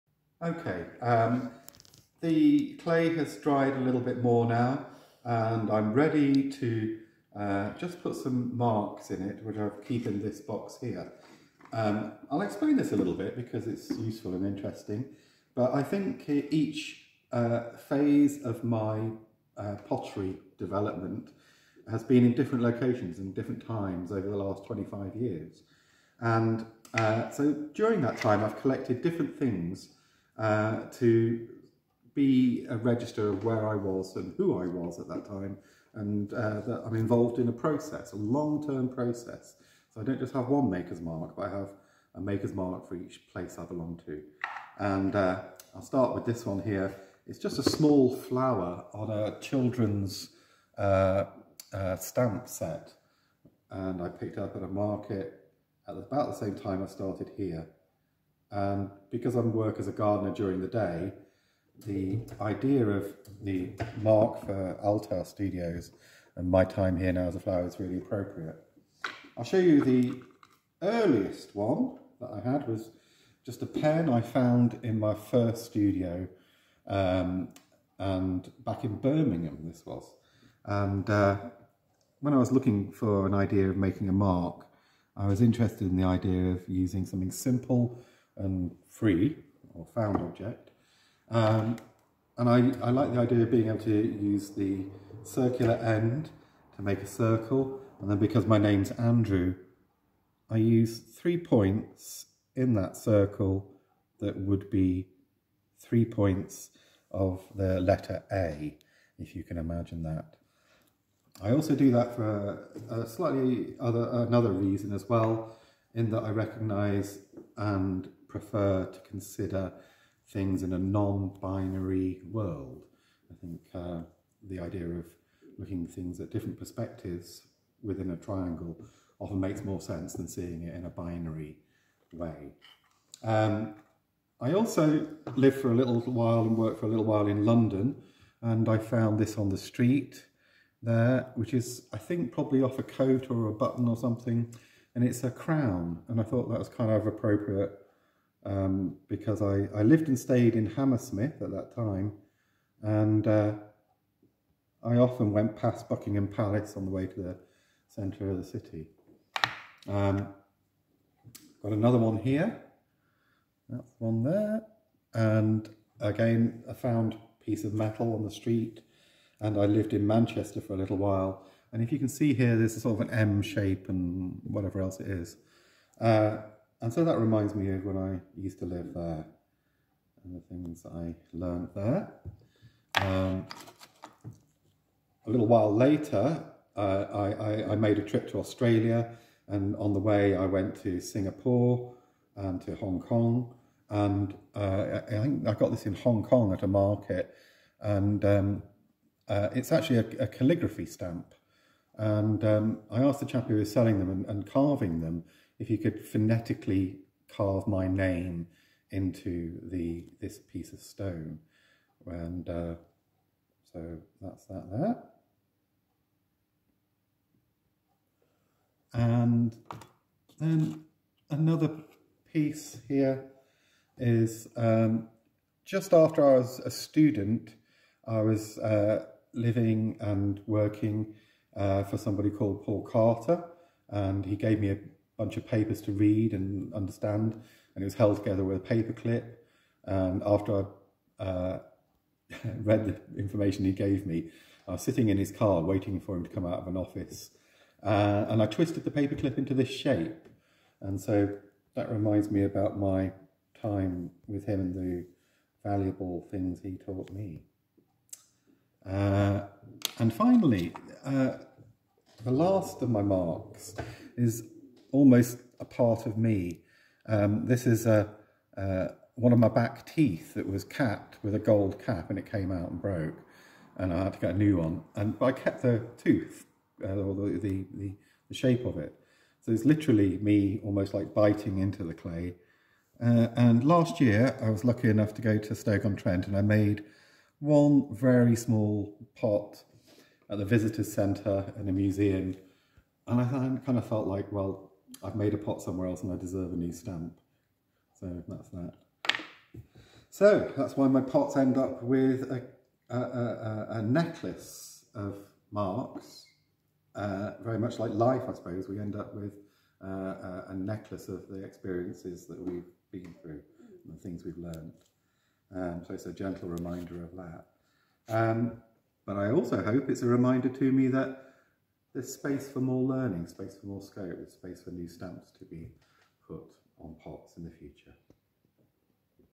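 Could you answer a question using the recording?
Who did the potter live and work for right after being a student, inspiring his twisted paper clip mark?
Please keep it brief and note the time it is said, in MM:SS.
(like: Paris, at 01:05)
Paul Carter, at 03:52.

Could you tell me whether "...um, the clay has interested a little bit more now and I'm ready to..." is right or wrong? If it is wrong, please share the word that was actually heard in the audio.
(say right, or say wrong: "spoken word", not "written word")
wrong: "dried", not "interested".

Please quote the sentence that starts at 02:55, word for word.
Uh, and so that reminds me of when I used to live there and the things I learned there.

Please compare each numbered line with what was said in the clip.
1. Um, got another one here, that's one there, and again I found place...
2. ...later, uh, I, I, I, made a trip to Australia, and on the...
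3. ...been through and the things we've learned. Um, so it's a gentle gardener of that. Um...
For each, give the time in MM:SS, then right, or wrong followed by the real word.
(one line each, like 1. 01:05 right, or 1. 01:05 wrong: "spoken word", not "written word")
1. 02:39 wrong: "piece", not "place"
2. 03:05 right
3. 05:12 wrong: "reminder", not "gardener".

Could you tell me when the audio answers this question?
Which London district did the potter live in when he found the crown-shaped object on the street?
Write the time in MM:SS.
02:30.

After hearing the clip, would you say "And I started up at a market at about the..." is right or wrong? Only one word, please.
wrong.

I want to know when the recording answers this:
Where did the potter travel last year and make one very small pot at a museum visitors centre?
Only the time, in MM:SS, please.
04:45.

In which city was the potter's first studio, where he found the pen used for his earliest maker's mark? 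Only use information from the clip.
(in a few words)
Birmingham.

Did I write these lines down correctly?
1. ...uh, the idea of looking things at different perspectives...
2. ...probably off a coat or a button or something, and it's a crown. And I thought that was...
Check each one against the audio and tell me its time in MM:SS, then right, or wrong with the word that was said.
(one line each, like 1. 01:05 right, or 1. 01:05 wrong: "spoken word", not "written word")
1. 02:03 right
2. 02:22 right.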